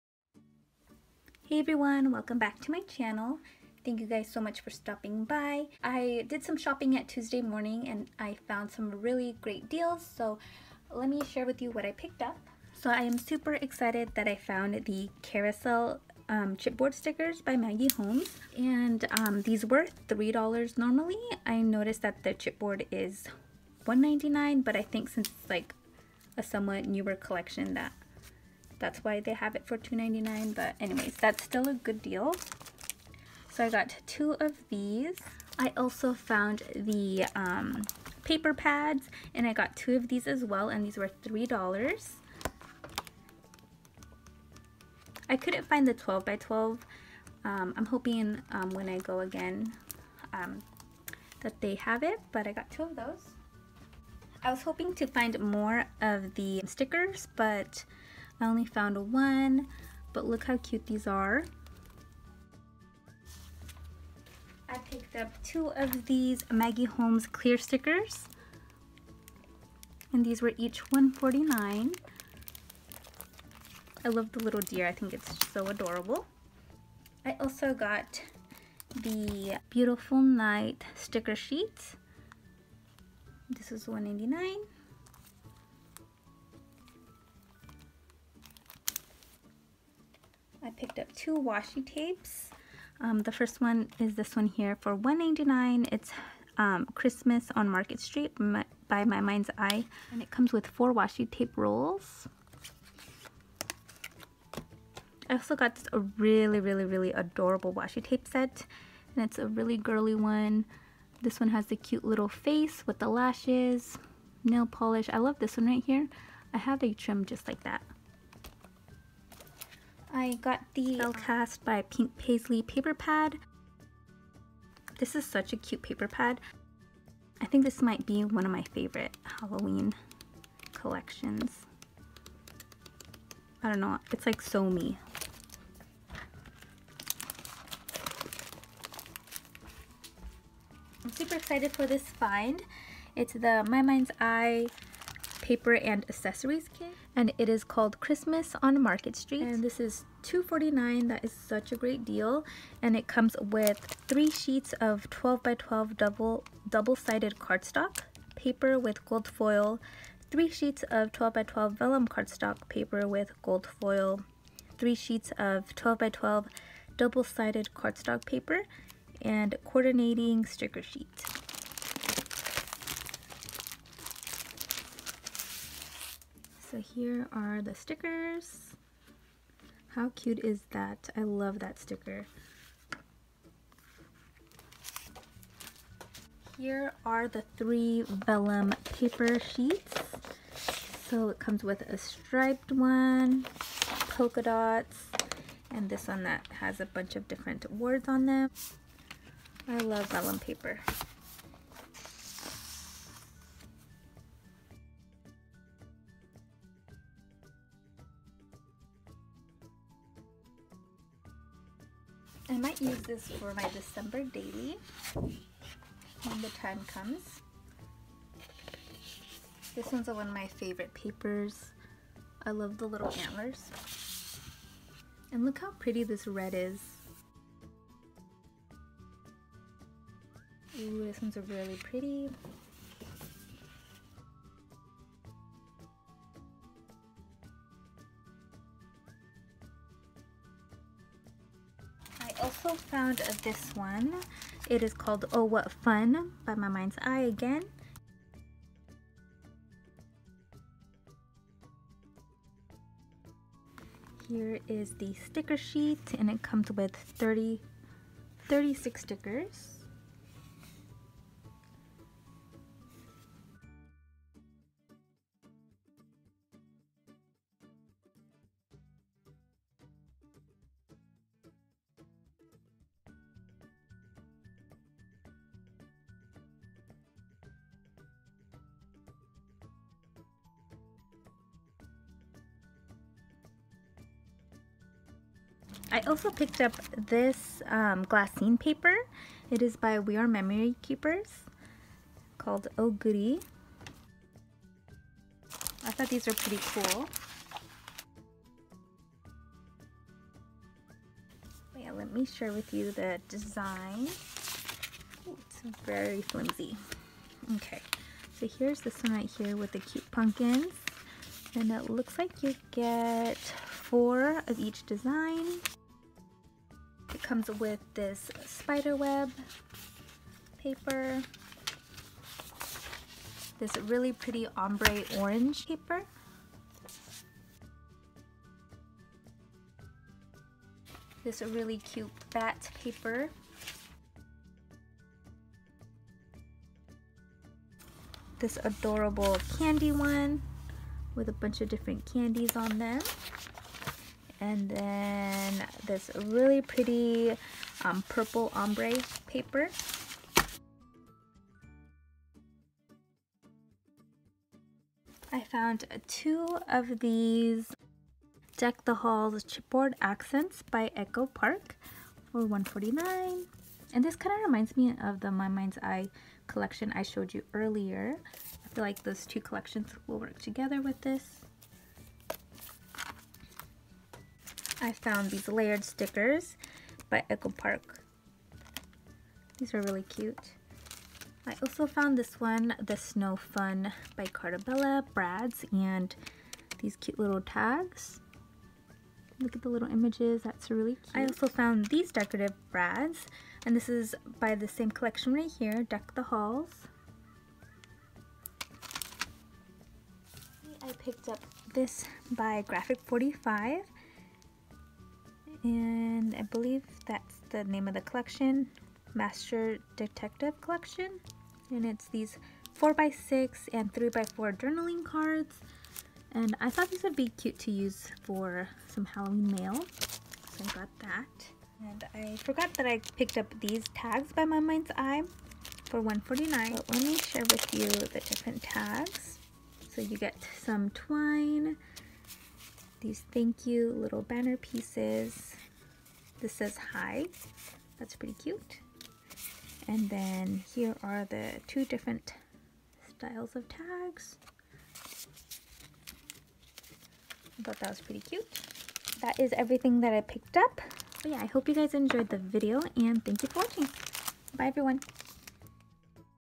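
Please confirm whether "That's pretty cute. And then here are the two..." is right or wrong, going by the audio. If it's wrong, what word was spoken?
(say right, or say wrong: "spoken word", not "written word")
right.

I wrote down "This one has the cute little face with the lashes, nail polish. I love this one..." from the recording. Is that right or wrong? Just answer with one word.
right.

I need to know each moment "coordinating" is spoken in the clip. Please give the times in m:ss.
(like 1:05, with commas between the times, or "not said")
2:49.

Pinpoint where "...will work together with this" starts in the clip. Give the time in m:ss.
6:10.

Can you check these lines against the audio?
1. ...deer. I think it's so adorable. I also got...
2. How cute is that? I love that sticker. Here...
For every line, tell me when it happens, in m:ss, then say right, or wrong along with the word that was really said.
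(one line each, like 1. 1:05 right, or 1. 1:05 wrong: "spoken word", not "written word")
1. 1:14 right
2. 2:59 right.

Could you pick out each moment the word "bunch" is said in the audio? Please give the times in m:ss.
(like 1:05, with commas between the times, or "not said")
3:16, 5:41.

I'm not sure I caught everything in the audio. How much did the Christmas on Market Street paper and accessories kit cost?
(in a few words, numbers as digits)
$2.49.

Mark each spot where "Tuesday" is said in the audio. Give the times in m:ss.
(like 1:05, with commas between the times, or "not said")
0:07.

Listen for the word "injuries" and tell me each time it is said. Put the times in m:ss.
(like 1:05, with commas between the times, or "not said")
not said.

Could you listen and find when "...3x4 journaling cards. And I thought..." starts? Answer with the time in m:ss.
6:53.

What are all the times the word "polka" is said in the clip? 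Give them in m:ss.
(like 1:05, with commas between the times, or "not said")
3:14.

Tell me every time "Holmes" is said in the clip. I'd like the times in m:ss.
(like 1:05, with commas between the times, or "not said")
0:17, 1:06.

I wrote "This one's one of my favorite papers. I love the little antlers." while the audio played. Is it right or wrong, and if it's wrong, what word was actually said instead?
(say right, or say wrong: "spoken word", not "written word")
right.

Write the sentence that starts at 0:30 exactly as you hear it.
But anyways, that's still a good deal.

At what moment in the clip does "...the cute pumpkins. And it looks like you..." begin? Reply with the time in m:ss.
5:09.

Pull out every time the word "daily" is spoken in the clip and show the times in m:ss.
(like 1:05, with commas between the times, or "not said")
3:34.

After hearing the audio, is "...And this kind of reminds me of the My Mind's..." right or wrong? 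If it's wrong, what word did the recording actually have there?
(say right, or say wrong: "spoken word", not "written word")
right.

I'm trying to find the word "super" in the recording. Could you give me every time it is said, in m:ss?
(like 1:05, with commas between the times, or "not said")
0:13, 2:21.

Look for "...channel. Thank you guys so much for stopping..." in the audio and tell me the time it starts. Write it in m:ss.
0:02.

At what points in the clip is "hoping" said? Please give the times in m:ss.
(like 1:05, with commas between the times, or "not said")
0:47, 0:54.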